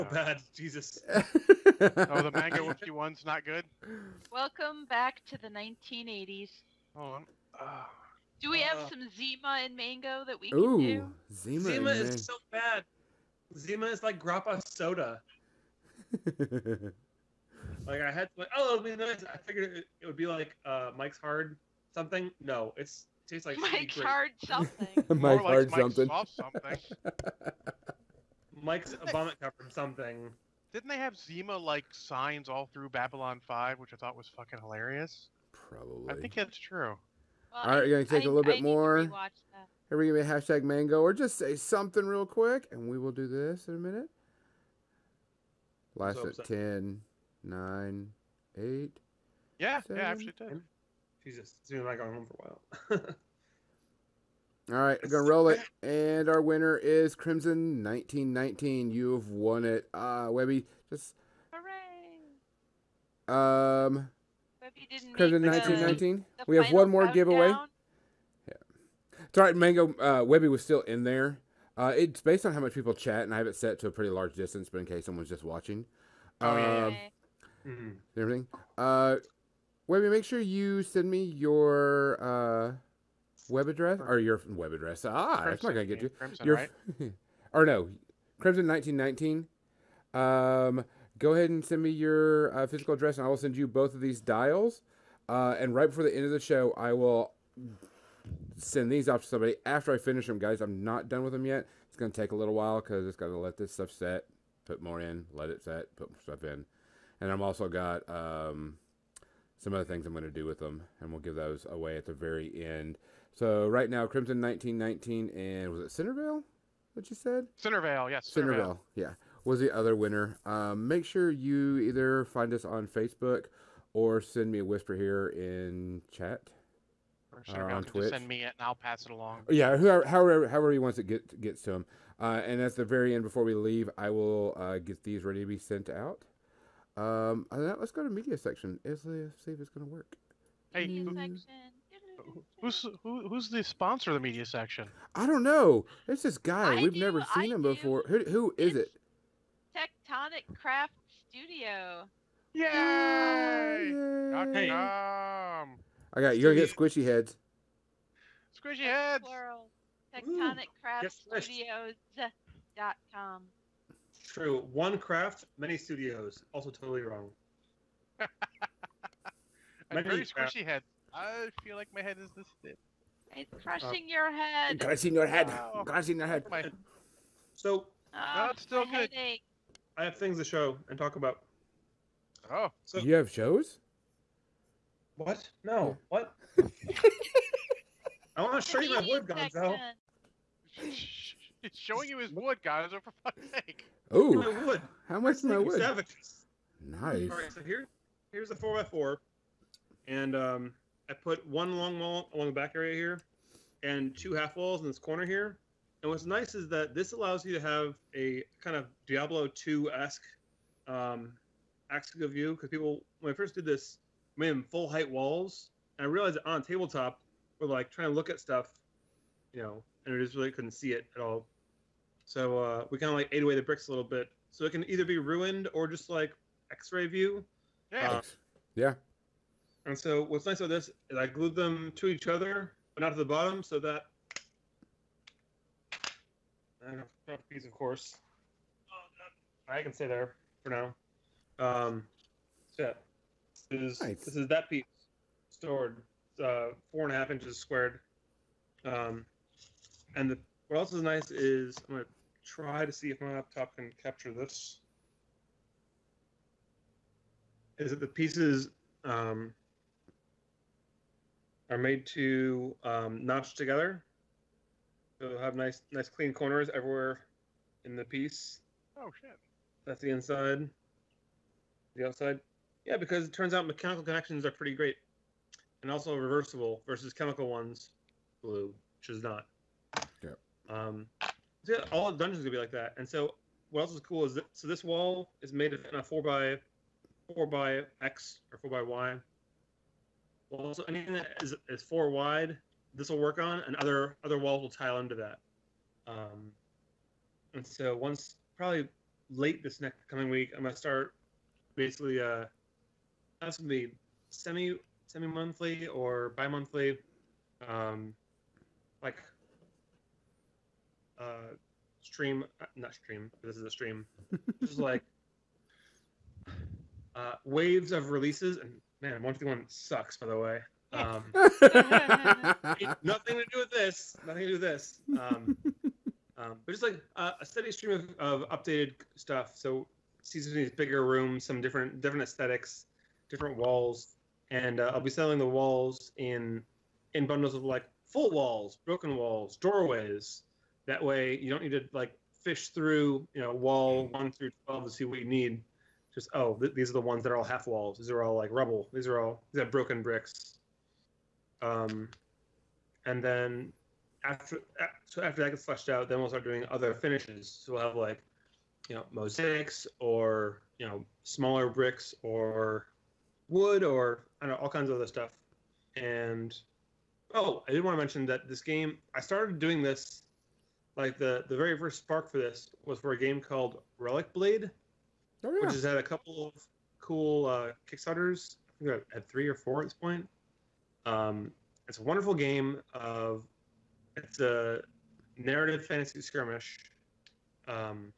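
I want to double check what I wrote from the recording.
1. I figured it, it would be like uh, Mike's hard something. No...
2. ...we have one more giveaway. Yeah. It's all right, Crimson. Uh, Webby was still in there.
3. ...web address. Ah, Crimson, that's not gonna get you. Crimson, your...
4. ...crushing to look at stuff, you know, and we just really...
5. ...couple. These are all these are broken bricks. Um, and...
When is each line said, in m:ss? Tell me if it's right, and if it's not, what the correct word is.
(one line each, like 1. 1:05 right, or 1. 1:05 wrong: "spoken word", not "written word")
1. 0:19 right
2. 1:06 wrong: "Mango", not "Crimson"
3. 1:24 right
4. 3:37 wrong: "trying", not "crushing"
5. 5:48 wrong: "rubble", not "couple".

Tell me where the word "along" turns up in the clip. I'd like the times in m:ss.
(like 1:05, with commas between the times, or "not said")
2:09, 3:22.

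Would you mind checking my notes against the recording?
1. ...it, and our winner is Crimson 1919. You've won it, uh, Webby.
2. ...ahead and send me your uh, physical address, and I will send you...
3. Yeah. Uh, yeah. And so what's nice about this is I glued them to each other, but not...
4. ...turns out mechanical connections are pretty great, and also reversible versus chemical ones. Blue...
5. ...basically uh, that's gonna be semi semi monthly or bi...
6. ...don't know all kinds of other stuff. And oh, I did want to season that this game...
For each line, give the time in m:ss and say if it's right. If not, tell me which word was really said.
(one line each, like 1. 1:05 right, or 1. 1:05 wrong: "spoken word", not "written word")
1. 0:55 right
2. 1:31 right
3. 3:47 right
4. 4:33 right
5. 5:01 right
6. 6:04 wrong: "mention", not "season".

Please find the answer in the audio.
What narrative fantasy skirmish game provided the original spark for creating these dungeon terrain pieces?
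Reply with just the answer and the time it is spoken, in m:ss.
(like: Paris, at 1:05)
Relic Blade, at 6:13.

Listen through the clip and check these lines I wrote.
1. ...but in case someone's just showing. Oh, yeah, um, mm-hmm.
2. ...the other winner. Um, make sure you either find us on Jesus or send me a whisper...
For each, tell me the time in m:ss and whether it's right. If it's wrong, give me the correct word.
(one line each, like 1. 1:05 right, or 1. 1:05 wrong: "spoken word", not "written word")
1. 1:14 wrong: "watching", not "showing"
2. 1:59 wrong: "Facebook", not "Jesus".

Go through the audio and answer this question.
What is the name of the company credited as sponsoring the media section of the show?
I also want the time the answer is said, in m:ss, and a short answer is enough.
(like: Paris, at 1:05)
Tectonic Craft Studio, at 2:29.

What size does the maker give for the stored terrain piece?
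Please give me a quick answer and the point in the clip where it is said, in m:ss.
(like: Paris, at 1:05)
4.5 inches, at 4:06.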